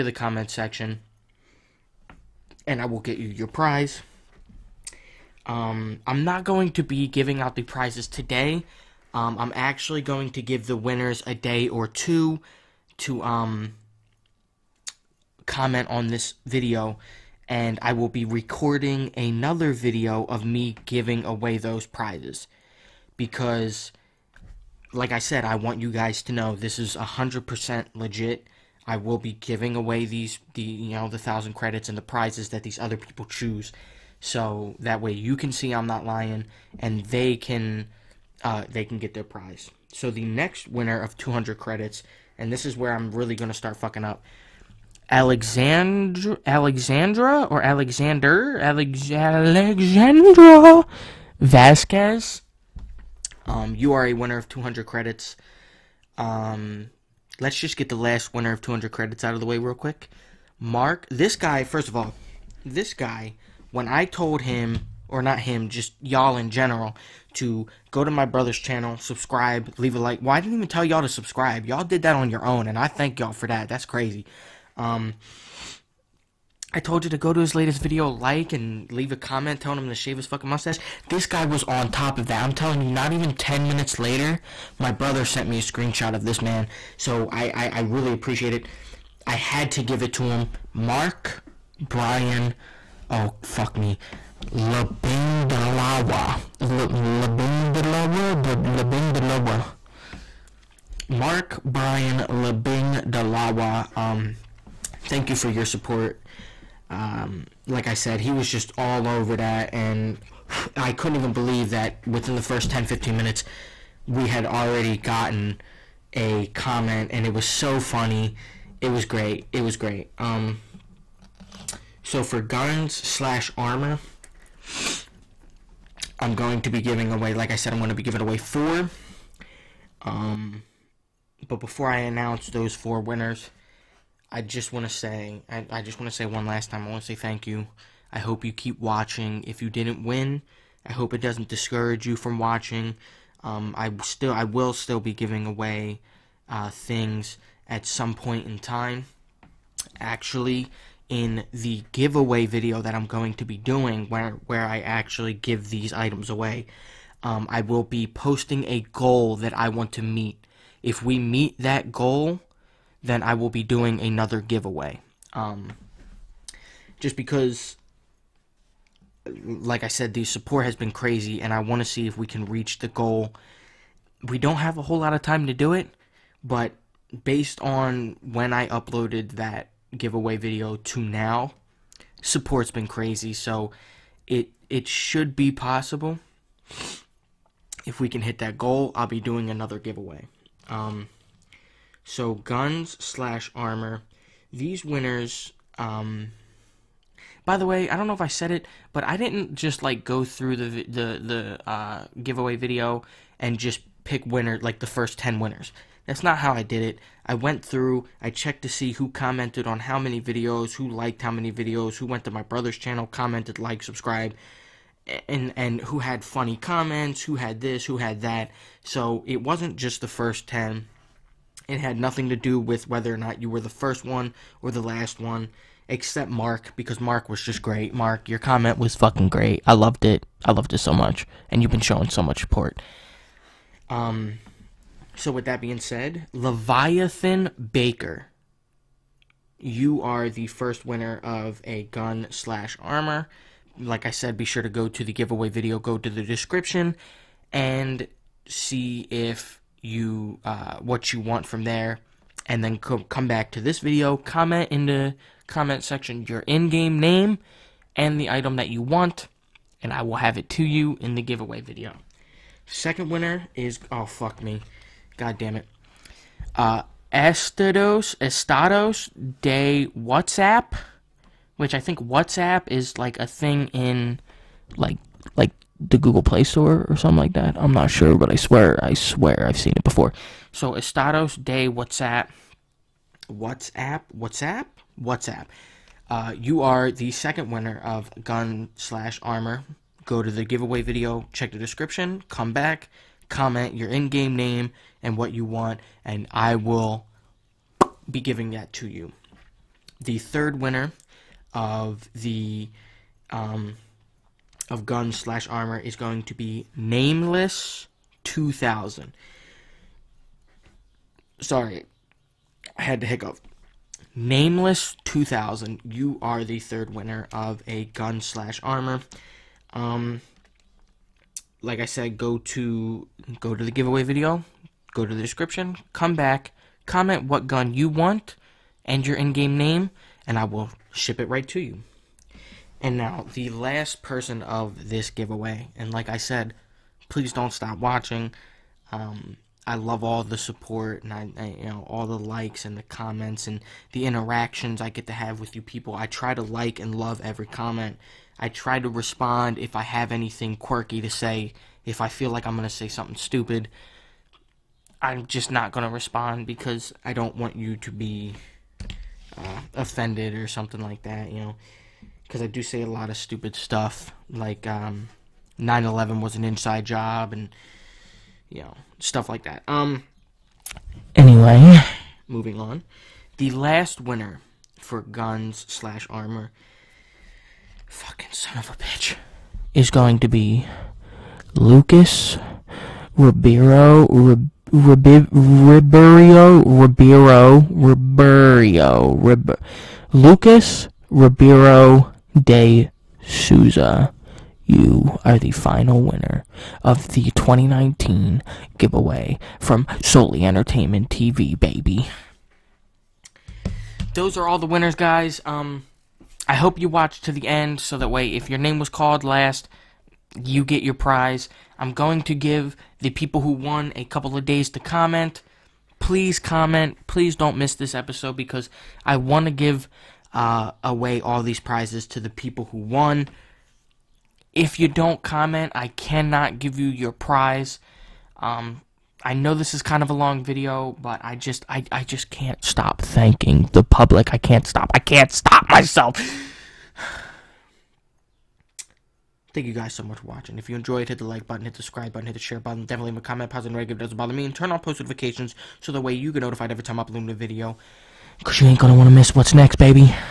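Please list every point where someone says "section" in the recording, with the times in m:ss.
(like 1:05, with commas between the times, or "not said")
0:00, 4:15.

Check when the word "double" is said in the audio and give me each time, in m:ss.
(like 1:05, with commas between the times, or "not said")
not said.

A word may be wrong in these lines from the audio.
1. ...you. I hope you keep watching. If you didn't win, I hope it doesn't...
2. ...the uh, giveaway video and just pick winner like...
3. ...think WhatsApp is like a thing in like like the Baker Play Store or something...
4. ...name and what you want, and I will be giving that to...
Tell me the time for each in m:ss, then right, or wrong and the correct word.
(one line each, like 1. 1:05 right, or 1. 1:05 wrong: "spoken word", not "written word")
1. 2:17 right
2. 3:21 right
3. 4:31 wrong: "Google", not "Baker"
4. 4:54 right.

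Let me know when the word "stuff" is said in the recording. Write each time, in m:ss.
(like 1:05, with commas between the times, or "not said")
6:03, 6:08.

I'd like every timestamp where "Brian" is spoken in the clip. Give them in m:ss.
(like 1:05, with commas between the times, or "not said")
1:31, 1:41.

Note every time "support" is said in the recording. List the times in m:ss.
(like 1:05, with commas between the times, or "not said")
1:45, 2:50, 3:02, 3:52, 5:40.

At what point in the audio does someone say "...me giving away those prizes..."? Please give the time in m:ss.
0:20.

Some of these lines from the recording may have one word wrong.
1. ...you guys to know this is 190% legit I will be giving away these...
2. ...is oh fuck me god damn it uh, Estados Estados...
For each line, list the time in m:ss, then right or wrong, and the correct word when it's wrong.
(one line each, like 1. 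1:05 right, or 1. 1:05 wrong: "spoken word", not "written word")
1. 0:25 wrong: "100", not "190"
2. 4:23 right.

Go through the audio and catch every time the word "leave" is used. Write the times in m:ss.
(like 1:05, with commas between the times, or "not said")
1:09, 1:18, 7:23.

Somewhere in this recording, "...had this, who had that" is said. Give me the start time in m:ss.
3:37.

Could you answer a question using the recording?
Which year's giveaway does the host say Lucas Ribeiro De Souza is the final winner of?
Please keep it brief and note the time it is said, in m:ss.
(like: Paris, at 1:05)
2019, at 6:37.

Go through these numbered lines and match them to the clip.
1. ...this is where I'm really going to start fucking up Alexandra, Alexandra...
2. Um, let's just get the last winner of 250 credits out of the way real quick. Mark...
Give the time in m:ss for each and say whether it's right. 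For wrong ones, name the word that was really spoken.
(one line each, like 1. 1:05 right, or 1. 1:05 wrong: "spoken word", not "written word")
1. 0:42 right
2. 0:56 wrong: "200", not "250".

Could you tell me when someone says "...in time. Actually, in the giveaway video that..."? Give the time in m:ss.
2:28.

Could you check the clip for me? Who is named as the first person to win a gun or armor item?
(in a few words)
Leviathan Baker.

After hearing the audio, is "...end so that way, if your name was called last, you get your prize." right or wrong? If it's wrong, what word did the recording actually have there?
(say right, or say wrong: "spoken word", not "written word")
right.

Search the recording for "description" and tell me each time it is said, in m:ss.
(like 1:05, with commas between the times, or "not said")
4:06, 4:51, 5:25.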